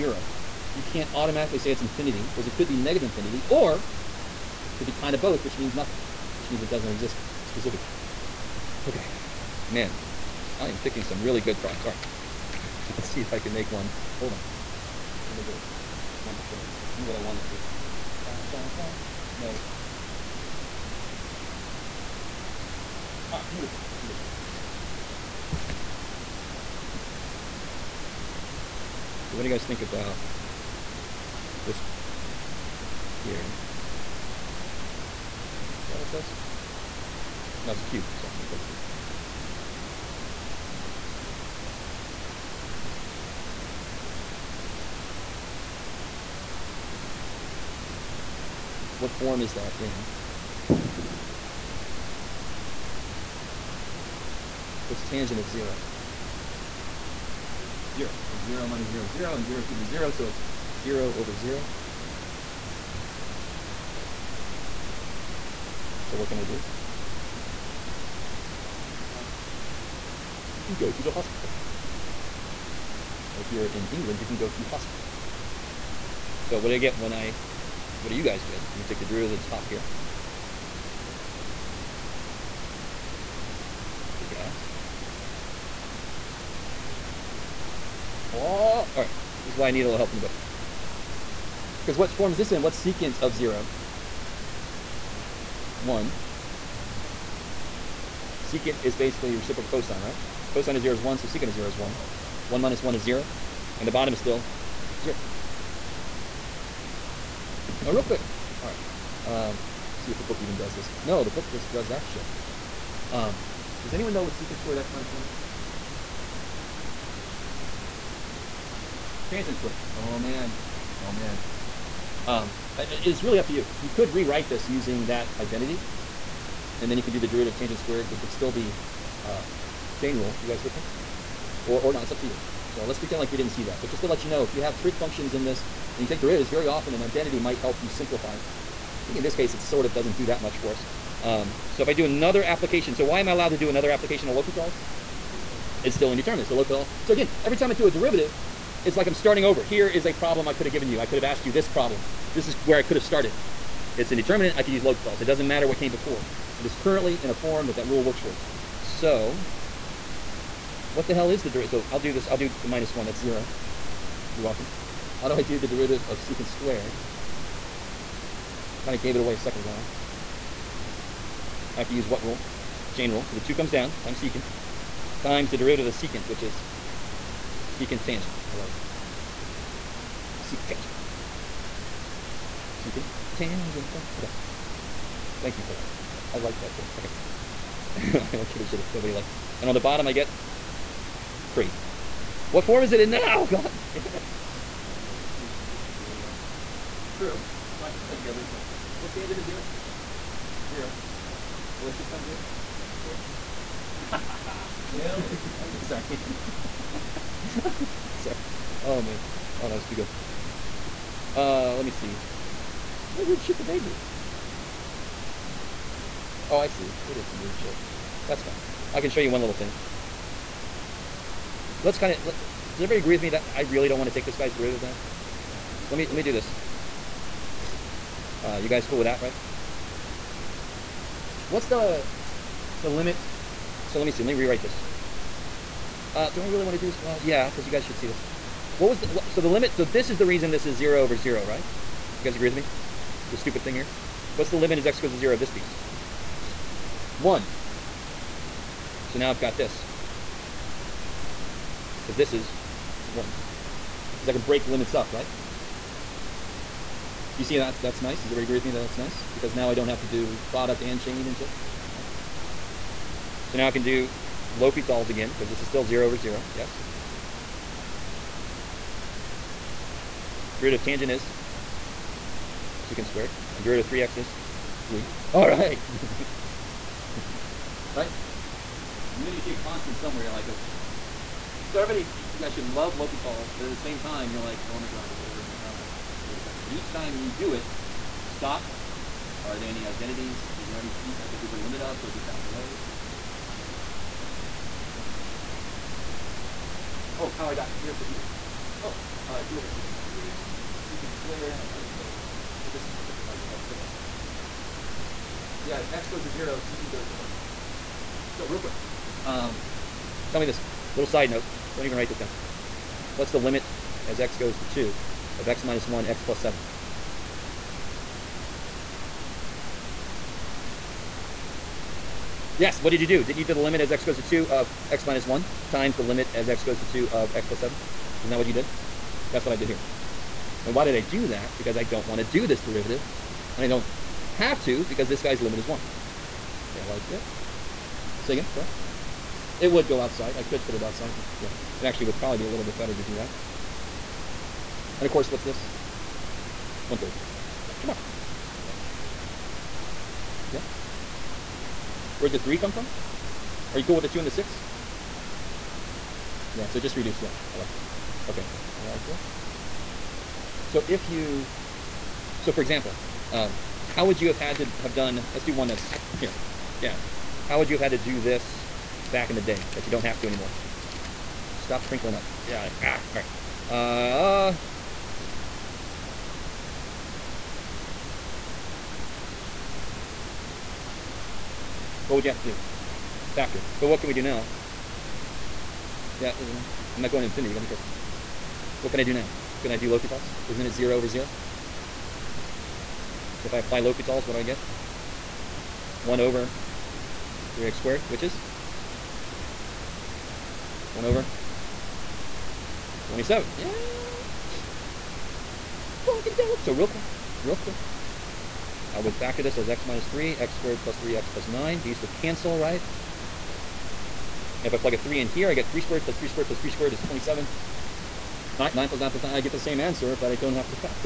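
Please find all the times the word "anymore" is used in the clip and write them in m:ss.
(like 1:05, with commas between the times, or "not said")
6:10.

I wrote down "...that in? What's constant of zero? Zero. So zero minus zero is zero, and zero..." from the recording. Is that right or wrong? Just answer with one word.
wrong.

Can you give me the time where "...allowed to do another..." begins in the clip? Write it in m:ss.
2:23.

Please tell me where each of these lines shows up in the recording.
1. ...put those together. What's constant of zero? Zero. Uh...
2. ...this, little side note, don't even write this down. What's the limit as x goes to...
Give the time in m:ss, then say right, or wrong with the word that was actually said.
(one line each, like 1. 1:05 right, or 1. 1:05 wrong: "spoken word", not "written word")
1. 3:17 wrong: "tangent", not "constant"
2. 5:10 right.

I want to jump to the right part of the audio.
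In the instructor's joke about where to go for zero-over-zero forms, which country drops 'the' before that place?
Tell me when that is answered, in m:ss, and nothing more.
1:13.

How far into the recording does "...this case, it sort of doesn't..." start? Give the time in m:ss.
2:19.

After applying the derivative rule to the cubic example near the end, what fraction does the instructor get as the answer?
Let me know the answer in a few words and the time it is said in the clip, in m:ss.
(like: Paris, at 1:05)
1/27, at 6:40.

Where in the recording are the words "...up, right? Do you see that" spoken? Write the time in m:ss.
4:14.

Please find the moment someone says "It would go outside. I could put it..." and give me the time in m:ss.
5:39.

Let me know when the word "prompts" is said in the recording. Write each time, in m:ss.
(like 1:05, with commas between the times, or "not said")
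0:11.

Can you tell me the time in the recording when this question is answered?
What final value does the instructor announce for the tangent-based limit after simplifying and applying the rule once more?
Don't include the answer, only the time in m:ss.
5:46.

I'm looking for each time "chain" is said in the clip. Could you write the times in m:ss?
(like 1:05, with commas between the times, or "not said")
2:09, 2:52, 4:20.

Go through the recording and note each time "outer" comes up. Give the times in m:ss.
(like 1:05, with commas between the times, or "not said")
not said.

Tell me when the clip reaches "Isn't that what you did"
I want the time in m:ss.
5:28.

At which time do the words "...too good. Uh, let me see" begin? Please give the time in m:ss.
3:29.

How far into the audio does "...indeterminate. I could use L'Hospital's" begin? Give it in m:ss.
2:34.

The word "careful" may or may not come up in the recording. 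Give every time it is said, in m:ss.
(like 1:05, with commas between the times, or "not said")
4:46, 6:27.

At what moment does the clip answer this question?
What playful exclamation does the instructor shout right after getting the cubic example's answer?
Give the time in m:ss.
6:46.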